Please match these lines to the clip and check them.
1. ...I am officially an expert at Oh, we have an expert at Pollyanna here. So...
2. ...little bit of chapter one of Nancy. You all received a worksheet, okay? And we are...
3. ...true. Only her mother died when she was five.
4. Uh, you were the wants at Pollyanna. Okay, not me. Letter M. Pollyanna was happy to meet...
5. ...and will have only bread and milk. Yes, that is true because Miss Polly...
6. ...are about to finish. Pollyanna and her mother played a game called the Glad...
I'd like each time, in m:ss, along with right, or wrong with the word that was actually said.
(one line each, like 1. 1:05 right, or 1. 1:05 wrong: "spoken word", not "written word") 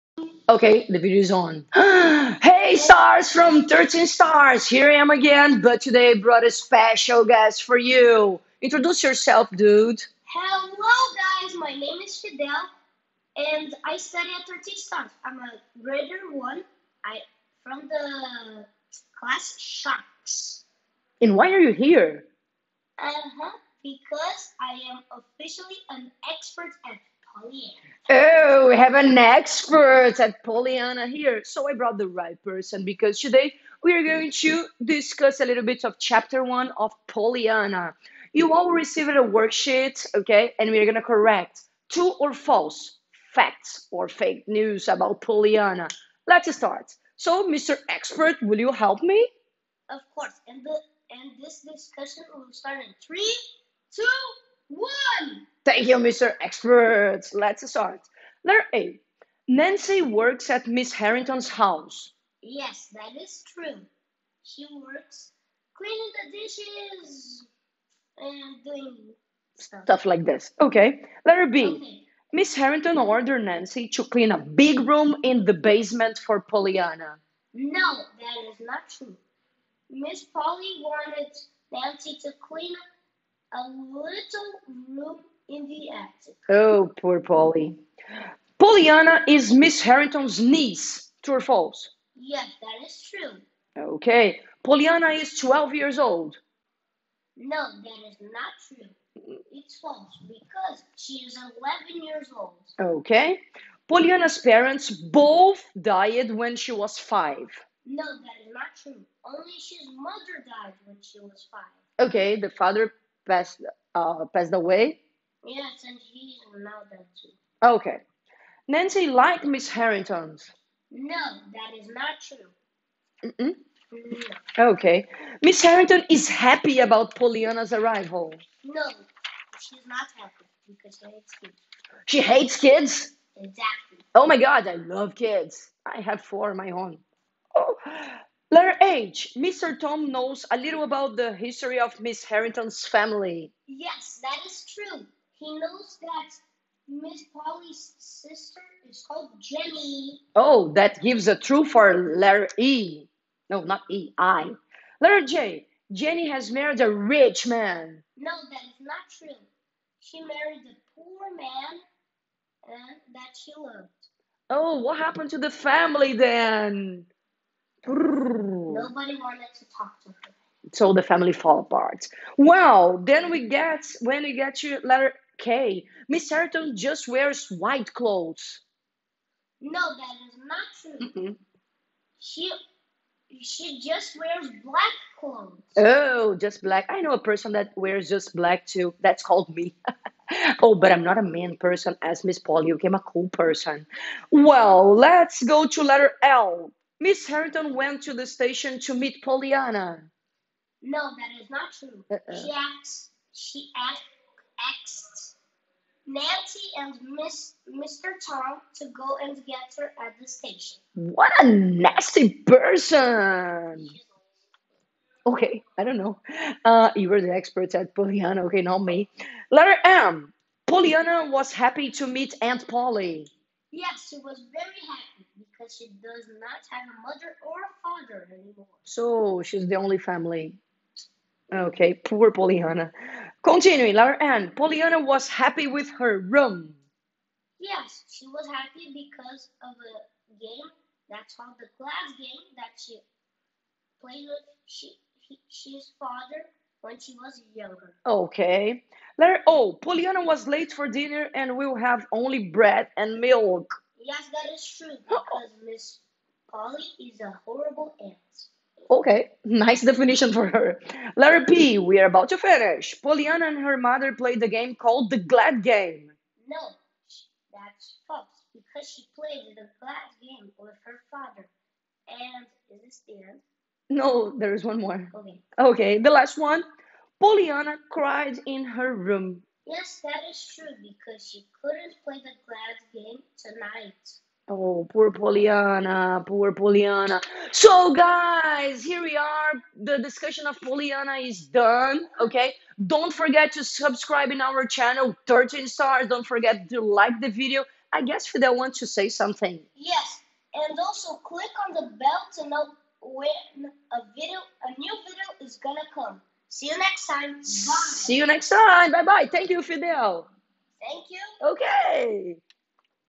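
1. 0:24 right
2. 0:35 wrong: "Pollyanna", not "Nancy"
3. 1:48 right
4. 3:36 wrong: "experts", not "wants"
5. 4:11 right
6. 4:21 right.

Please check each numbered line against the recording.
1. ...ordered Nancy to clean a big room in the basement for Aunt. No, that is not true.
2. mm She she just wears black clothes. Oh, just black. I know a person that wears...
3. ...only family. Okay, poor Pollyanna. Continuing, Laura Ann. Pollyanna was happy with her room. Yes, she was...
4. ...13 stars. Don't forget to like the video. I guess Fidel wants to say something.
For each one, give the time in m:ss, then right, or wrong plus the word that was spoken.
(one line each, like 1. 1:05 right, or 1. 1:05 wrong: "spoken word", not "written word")
1. 1:12 wrong: "Pollyanna", not "Aunt"
2. 3:01 right
3. 3:49 right
4. 4:55 right.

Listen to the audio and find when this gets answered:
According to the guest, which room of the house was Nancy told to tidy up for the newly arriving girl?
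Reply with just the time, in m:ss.
1:23.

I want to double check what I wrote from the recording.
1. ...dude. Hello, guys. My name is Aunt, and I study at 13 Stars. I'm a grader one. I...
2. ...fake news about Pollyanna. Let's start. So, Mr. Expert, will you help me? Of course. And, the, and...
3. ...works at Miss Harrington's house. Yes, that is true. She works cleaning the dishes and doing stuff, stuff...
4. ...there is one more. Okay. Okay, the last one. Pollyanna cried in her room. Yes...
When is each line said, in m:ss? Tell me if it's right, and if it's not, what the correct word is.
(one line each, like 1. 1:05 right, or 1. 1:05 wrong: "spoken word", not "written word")
1. 0:09 wrong: "Fidel", not "Aunt"
2. 0:44 right
3. 1:00 right
4. 4:34 right.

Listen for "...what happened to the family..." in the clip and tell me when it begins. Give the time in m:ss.
2:44.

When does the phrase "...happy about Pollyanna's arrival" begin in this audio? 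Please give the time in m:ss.
2:06.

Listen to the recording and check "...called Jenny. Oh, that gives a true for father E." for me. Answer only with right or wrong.
wrong.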